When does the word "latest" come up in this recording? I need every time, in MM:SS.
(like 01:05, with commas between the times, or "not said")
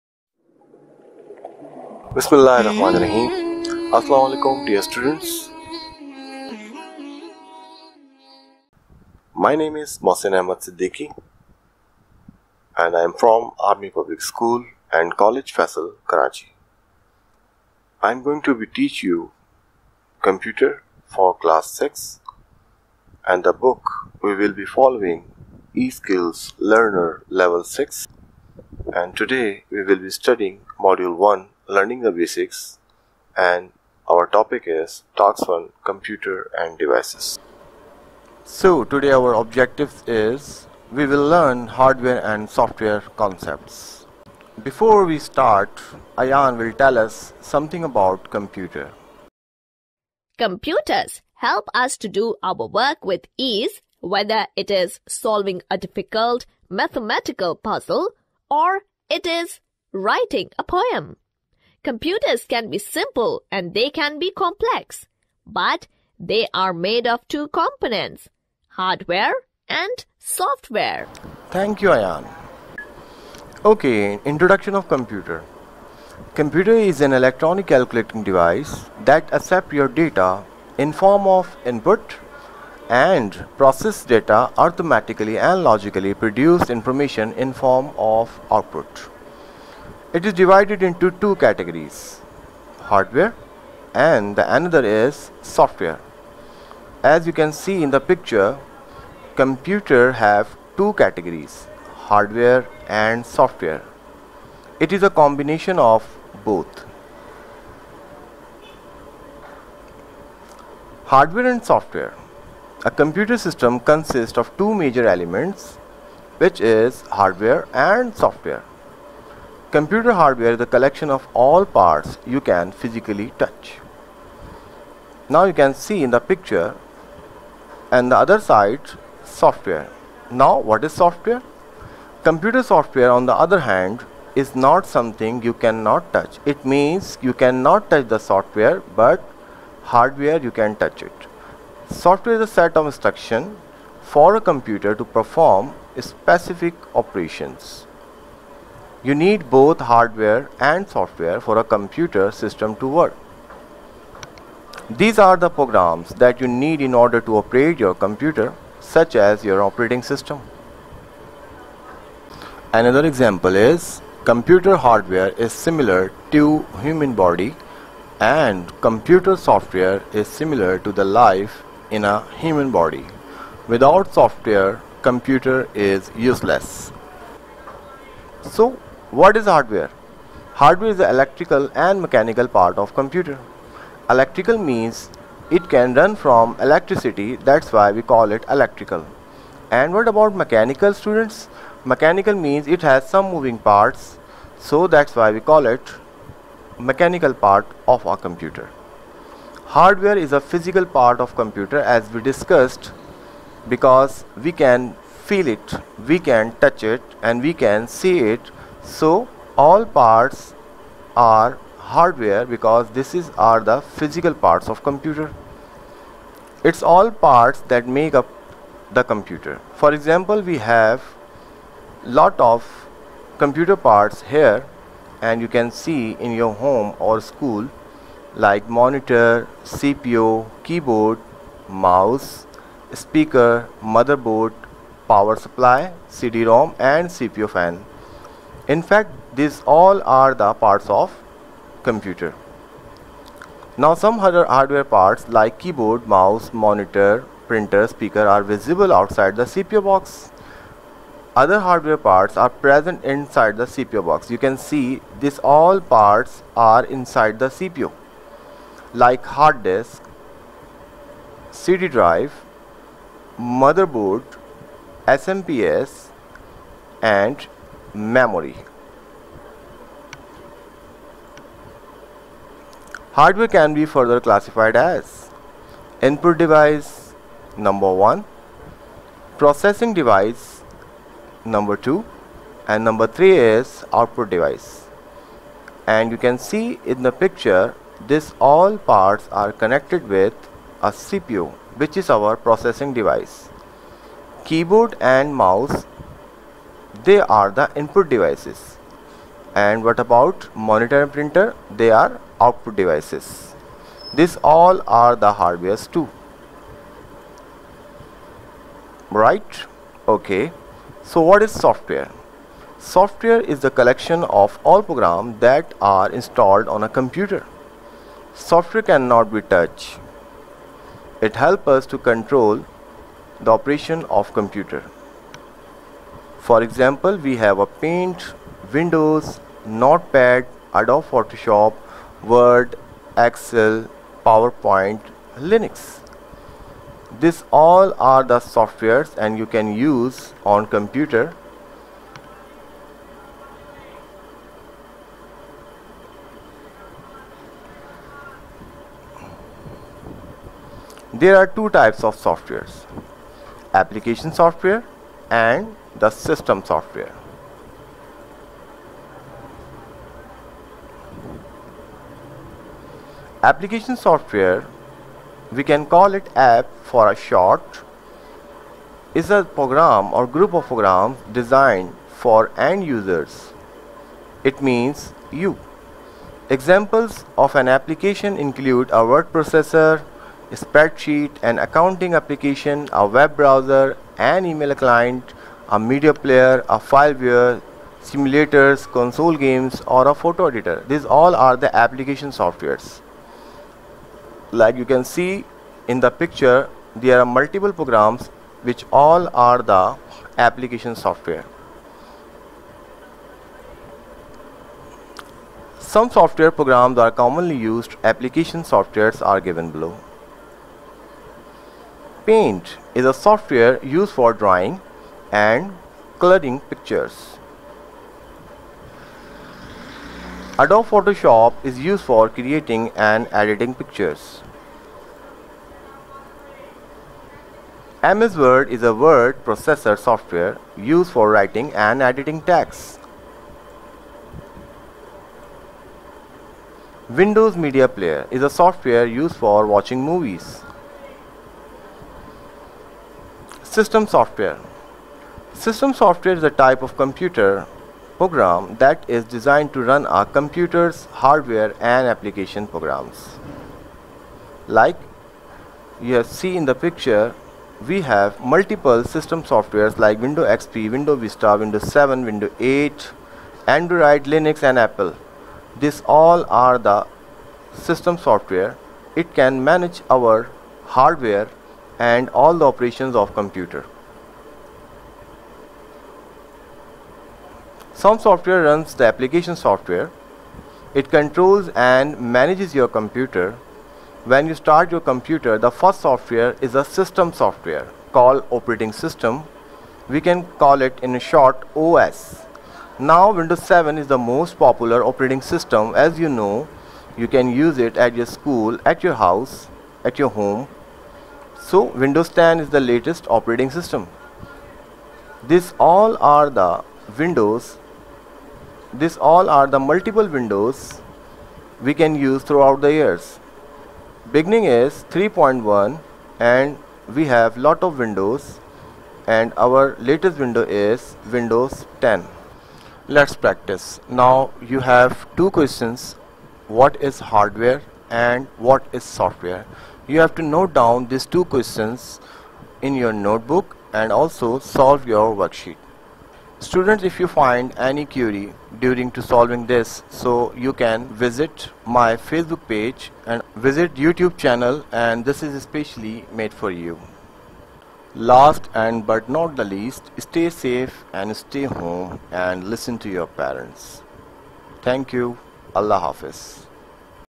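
08:22, 08:39.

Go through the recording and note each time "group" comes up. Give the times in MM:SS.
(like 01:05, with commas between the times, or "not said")
06:10.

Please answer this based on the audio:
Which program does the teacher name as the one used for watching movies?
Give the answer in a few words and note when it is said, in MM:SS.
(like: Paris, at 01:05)
Windows Media Player, at 07:17.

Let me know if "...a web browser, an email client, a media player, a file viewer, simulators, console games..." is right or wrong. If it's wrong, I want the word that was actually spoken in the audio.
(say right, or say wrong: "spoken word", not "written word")
right.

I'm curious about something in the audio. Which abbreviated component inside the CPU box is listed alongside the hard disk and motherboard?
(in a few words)
SMPS.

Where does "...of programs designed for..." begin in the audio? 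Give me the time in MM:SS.
06:10.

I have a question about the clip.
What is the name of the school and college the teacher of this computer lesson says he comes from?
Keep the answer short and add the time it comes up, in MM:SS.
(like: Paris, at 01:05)
Army Public School and College Faisal, at 00:13.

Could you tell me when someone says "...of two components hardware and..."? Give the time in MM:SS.
01:07.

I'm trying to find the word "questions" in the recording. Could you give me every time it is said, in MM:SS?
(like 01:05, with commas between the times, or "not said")
08:45, 08:51.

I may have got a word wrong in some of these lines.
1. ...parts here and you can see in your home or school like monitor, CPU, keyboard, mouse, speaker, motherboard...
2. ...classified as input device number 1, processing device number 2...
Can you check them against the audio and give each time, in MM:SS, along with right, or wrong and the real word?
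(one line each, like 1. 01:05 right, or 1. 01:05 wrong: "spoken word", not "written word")
1. 03:43 right
2. 04:34 right.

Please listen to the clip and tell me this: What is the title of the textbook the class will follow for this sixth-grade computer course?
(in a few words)
eSkills Learner Level 6.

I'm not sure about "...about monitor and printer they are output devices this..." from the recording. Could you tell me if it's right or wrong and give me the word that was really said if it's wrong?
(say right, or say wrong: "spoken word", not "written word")
right.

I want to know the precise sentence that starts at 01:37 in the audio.
As you can see in the picture, computer have two categories, hardware and software.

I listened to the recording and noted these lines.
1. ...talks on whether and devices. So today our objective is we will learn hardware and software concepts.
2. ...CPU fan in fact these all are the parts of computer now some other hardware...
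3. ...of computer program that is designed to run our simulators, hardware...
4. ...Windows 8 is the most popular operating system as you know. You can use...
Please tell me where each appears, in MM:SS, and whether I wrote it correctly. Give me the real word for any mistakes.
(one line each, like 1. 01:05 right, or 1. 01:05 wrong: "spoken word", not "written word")
1. 00:35 wrong: "computer", not "whether"
2. 03:57 right
3. 07:26 wrong: "computers", not "simulators"
4. 08:13 wrong: "7", not "8".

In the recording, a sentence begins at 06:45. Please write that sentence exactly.
Some software programs are commonly used.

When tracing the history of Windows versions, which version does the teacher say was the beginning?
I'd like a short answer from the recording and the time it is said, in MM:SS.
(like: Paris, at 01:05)
3.1, at 08:35.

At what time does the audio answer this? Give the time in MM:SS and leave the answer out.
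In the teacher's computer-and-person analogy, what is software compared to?
02:51.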